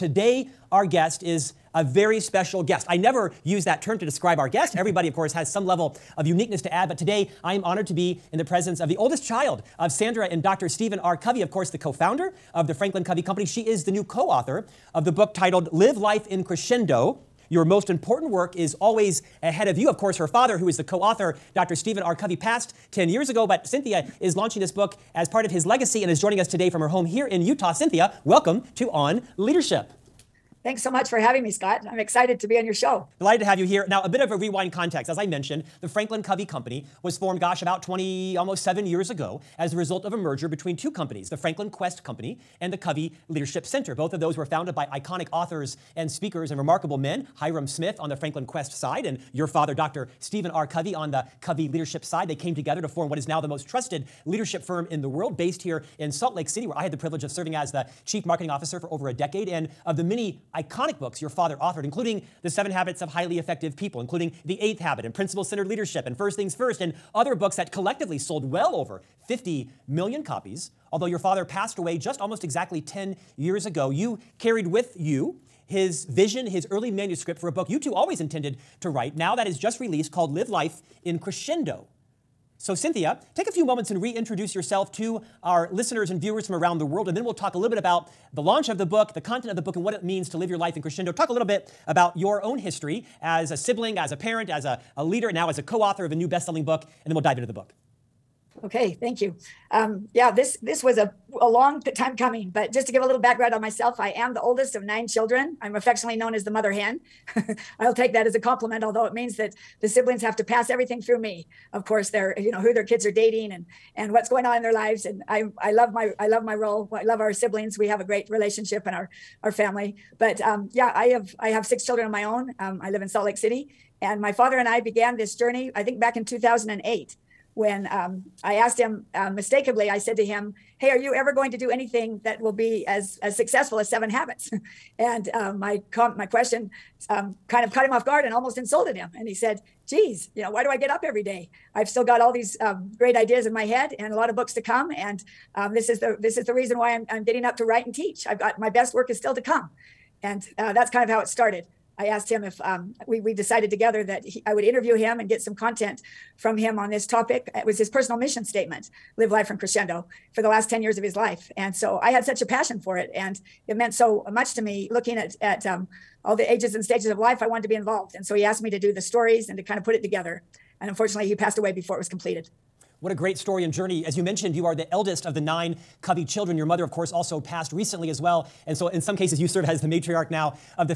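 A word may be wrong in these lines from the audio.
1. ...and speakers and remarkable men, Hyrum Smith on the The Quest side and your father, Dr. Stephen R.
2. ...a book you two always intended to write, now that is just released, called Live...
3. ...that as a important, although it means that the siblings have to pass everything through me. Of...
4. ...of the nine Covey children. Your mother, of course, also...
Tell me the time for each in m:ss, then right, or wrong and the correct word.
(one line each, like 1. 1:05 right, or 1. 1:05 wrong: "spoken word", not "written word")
1. 0:45 wrong: "Franklin", not "The"
2. 1:17 right
3. 1:48 wrong: "compliment", not "important"
4. 2:55 right.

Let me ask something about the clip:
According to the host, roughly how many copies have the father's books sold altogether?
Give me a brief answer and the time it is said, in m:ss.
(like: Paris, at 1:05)
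50 million, at 1:09.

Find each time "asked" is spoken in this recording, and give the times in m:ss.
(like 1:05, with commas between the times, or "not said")
2:08, 2:32, 2:48.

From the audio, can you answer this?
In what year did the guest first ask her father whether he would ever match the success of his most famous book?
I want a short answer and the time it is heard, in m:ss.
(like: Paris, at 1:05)
2008, at 2:06.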